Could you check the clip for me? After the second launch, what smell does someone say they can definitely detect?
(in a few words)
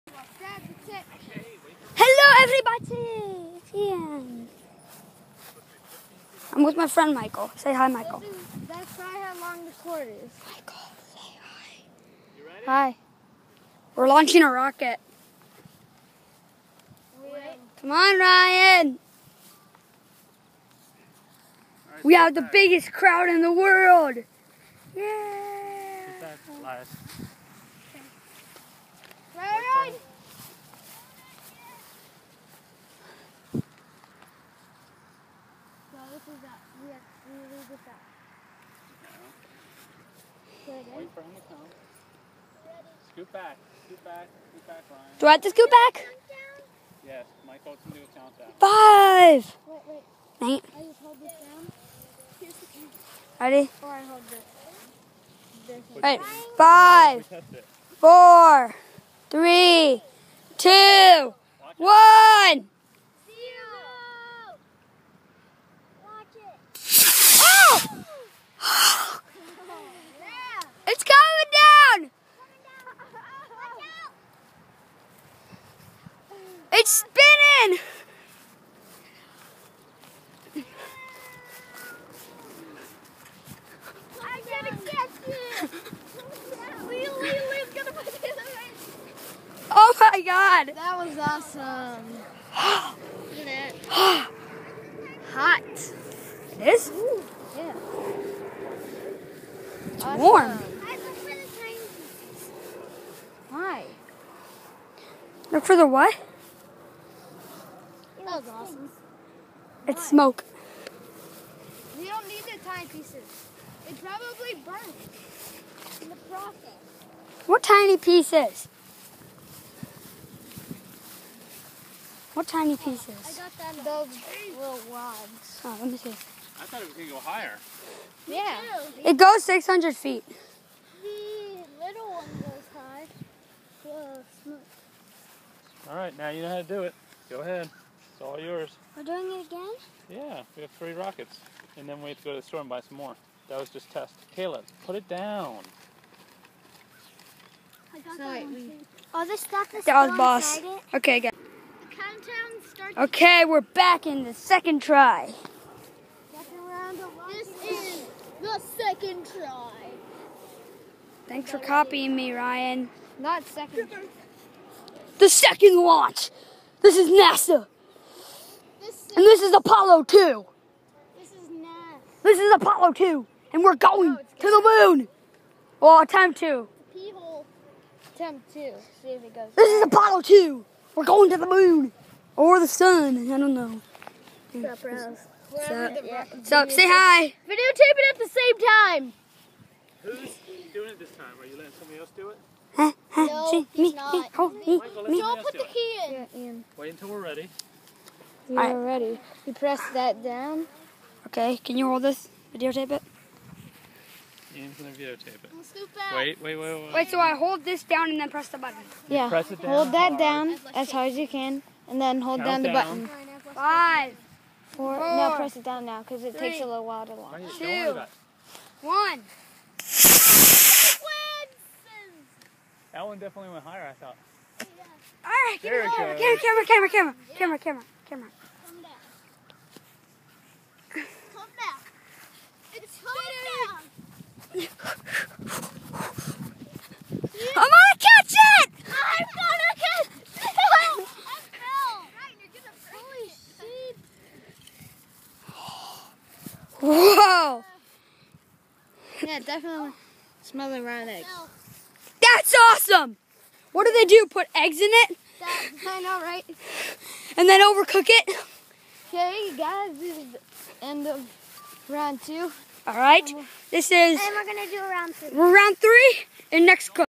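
Rotten eggs.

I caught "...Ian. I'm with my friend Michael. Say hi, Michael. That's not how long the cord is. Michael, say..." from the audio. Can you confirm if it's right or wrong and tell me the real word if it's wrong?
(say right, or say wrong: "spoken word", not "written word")
right.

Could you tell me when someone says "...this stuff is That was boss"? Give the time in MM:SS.
02:29.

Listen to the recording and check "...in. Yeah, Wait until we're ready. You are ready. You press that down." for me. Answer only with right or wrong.
right.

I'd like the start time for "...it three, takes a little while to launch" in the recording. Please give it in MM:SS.
03:36.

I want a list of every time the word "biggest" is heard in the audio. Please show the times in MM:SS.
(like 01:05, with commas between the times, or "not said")
00:22.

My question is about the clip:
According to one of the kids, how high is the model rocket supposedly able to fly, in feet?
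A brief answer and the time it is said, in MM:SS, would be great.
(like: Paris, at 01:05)
600 feet, at 02:09.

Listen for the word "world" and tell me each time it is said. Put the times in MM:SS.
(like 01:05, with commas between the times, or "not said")
00:23.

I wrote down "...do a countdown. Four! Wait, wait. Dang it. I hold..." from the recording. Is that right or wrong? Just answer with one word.
wrong.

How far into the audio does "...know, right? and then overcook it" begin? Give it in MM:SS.
04:16.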